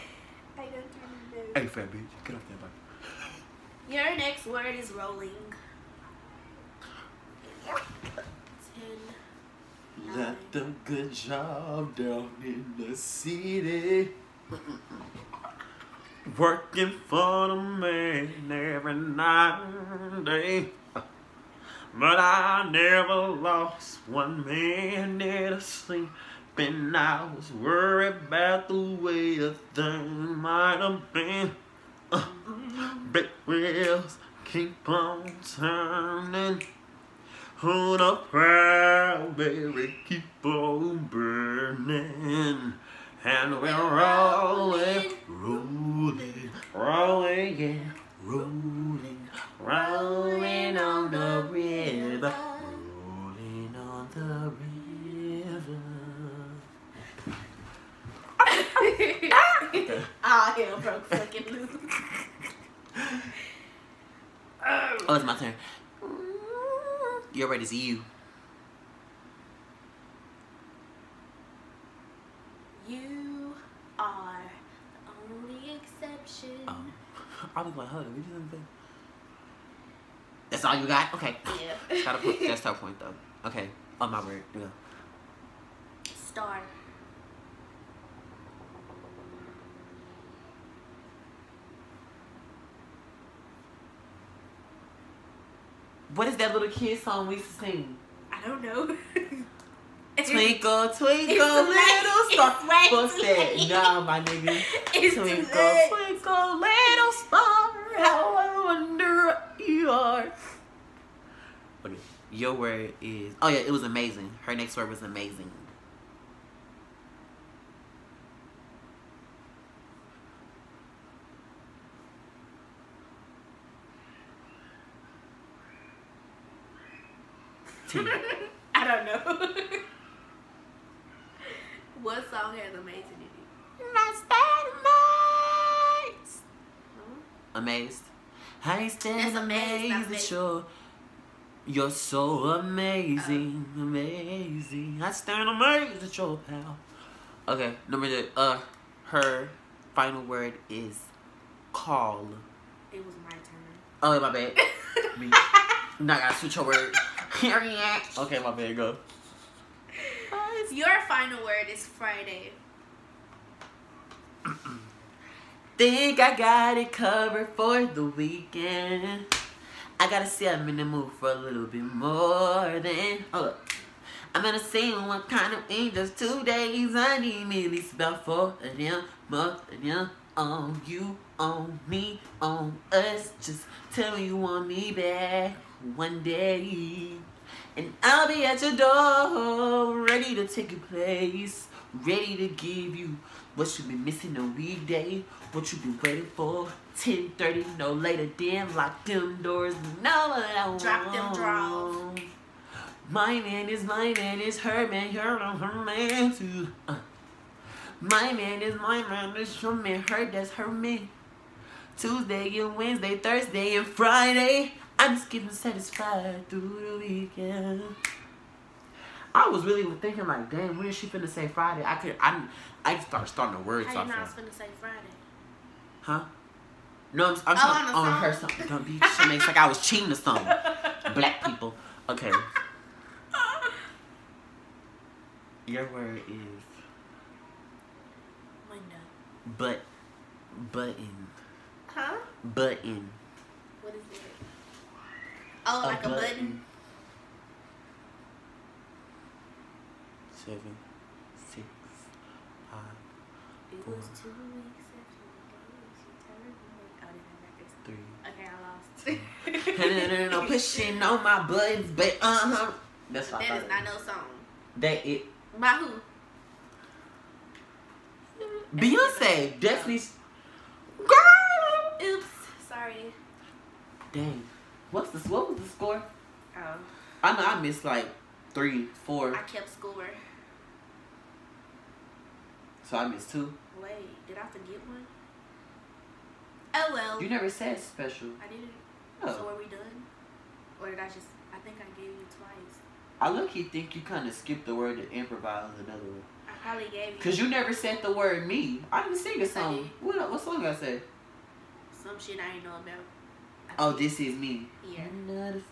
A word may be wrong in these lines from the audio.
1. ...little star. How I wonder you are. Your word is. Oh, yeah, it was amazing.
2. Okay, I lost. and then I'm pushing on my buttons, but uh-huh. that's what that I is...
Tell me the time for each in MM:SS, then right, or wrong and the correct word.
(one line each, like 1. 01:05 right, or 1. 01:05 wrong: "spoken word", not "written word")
1. 01:46 right
2. 04:19 right.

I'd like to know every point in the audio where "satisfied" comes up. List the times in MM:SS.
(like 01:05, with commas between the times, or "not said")
03:35.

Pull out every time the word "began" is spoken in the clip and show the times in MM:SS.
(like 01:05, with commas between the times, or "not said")
not said.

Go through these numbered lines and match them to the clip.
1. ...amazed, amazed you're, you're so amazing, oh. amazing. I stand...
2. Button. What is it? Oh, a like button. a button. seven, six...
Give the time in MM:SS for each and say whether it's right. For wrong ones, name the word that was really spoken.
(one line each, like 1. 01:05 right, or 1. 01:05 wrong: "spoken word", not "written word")
1. 02:19 right
2. 04:02 right.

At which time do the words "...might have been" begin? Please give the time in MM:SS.
00:30.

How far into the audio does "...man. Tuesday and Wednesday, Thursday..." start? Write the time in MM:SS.
03:30.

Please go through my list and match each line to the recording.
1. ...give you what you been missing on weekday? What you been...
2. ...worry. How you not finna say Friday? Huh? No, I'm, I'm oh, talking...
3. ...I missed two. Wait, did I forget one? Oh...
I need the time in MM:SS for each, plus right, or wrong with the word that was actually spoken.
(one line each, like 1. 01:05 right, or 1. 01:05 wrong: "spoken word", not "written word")
1. 03:12 right
2. 03:43 right
3. 04:42 right.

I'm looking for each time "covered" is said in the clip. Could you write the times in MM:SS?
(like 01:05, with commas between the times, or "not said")
02:46.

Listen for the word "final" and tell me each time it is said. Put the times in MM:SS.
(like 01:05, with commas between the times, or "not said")
02:29, 02:41.